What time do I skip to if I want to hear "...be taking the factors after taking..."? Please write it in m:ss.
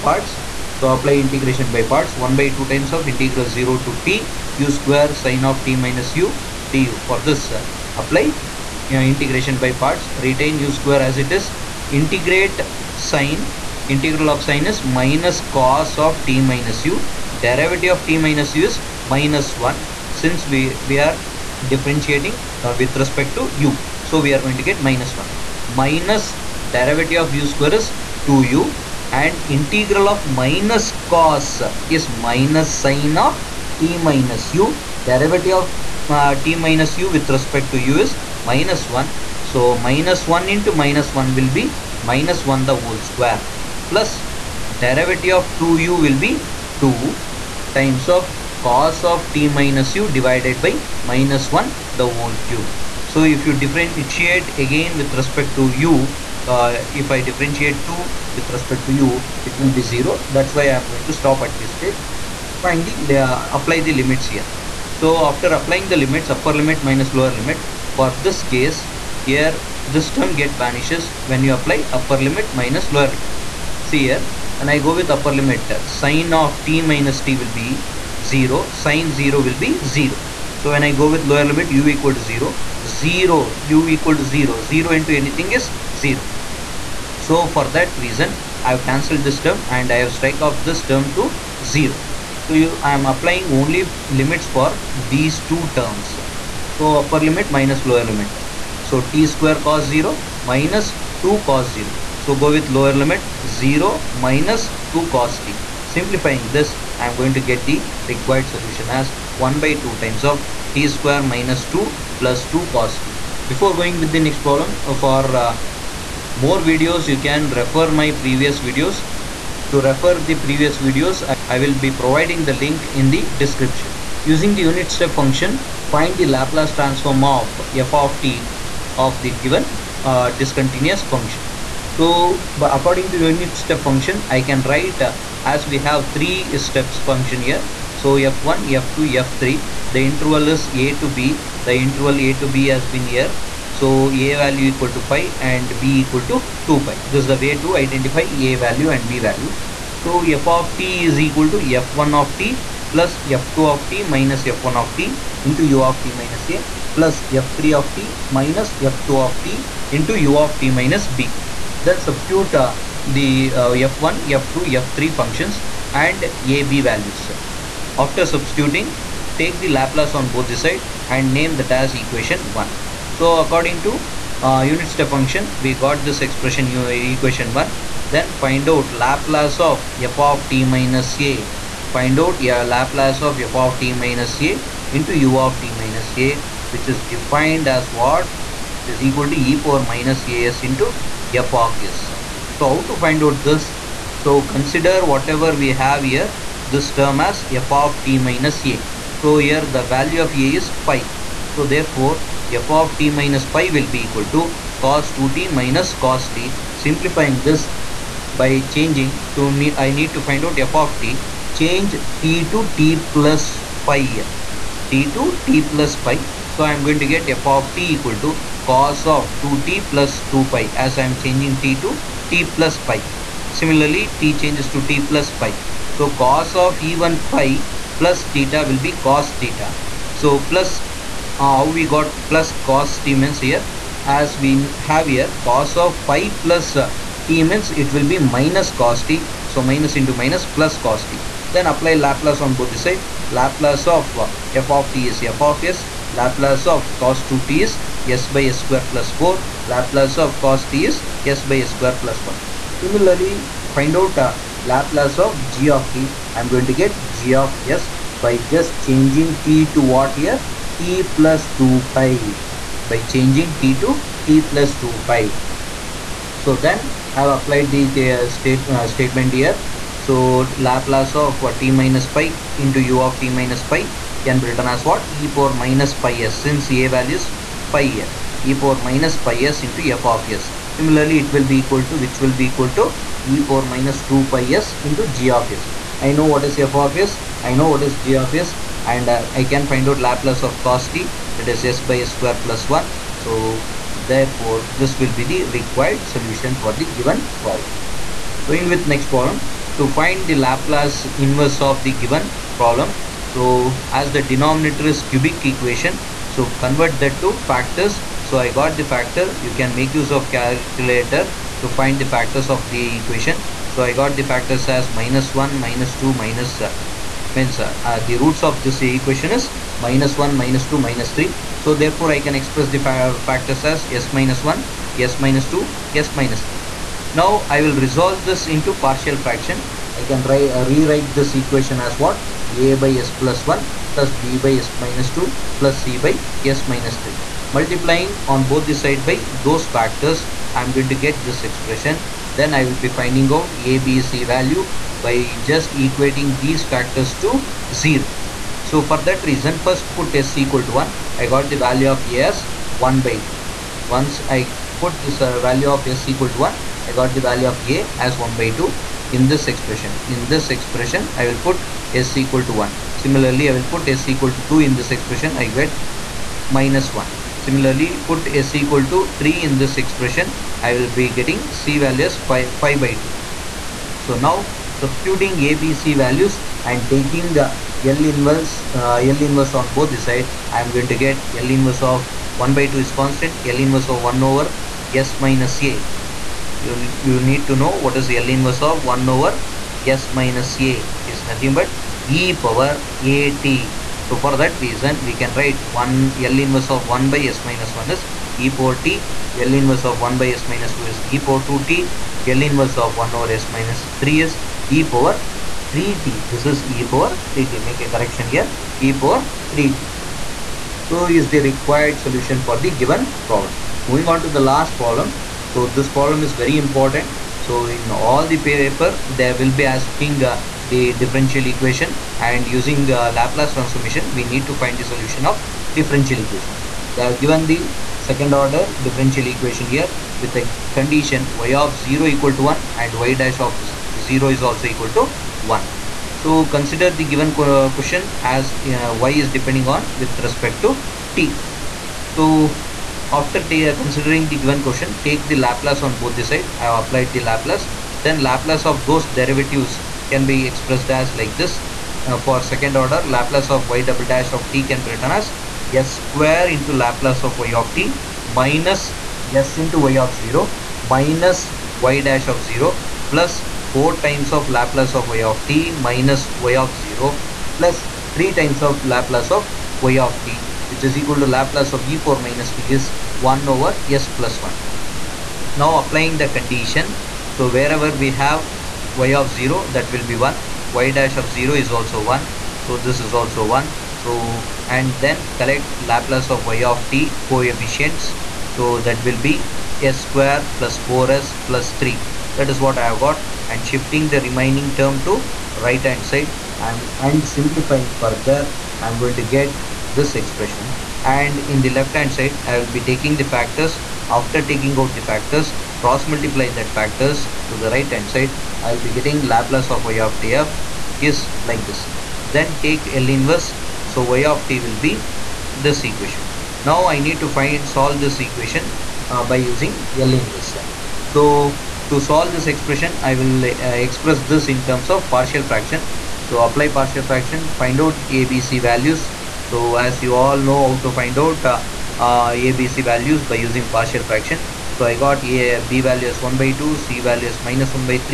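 8:22.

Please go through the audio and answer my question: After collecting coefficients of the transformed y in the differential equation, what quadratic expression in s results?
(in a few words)
s^2 + 4s + 3.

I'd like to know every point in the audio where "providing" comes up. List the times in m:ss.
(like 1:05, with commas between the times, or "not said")
2:01.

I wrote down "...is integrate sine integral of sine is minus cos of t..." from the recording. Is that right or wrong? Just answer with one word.
right.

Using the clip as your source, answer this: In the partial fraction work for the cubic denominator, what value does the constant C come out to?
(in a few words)
5/2.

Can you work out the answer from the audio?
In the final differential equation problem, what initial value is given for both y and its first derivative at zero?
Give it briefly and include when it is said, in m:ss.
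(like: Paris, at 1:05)
1, at 7:14.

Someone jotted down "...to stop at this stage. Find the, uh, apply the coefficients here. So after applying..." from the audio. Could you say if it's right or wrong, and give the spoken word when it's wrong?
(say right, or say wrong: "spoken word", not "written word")
wrong: "limits", not "coefficients".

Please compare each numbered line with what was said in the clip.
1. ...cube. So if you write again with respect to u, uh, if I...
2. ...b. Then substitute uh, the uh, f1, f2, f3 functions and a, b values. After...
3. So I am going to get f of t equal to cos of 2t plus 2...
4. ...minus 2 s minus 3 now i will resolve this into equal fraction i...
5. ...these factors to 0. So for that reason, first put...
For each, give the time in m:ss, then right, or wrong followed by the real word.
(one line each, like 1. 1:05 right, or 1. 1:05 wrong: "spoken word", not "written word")
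1. 0:52 wrong: "differentiate", not "write"
2. 2:41 right
3. 3:36 right
4. 5:25 wrong: "partial", not "equal"
5. 5:46 right.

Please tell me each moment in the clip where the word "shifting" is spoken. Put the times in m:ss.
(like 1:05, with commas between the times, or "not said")
8:13.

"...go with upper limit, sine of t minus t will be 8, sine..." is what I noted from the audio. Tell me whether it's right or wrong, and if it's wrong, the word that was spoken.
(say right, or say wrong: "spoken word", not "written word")
wrong: "0", not "8".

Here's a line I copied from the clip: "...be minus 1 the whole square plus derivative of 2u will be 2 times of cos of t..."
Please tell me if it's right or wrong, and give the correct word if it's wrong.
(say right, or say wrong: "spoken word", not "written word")
right.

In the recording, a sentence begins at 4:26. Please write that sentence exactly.
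So then I have applied the, the uh, state, uh, statement here.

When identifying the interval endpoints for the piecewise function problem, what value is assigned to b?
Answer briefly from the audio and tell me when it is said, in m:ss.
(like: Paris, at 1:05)
2 pi, at 2:25.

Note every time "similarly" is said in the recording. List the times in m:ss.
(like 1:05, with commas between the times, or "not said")
3:43, 4:12, 4:40, 6:02, 6:07.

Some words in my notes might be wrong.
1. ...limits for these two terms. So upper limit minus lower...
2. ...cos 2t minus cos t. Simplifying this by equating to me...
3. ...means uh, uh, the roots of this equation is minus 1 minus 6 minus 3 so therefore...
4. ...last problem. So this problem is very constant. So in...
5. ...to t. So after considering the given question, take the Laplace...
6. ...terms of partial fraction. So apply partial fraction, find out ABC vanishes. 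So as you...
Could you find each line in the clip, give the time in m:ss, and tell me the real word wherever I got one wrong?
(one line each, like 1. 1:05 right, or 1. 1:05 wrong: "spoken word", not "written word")
1. 1:34 right
2. 3:24 wrong: "changing", not "equating"
3. 5:17 wrong: "2", not "6"
4. 6:54 wrong: "important", not "constant"
5. 7:20 right
6. 8:44 wrong: "values", not "vanishes".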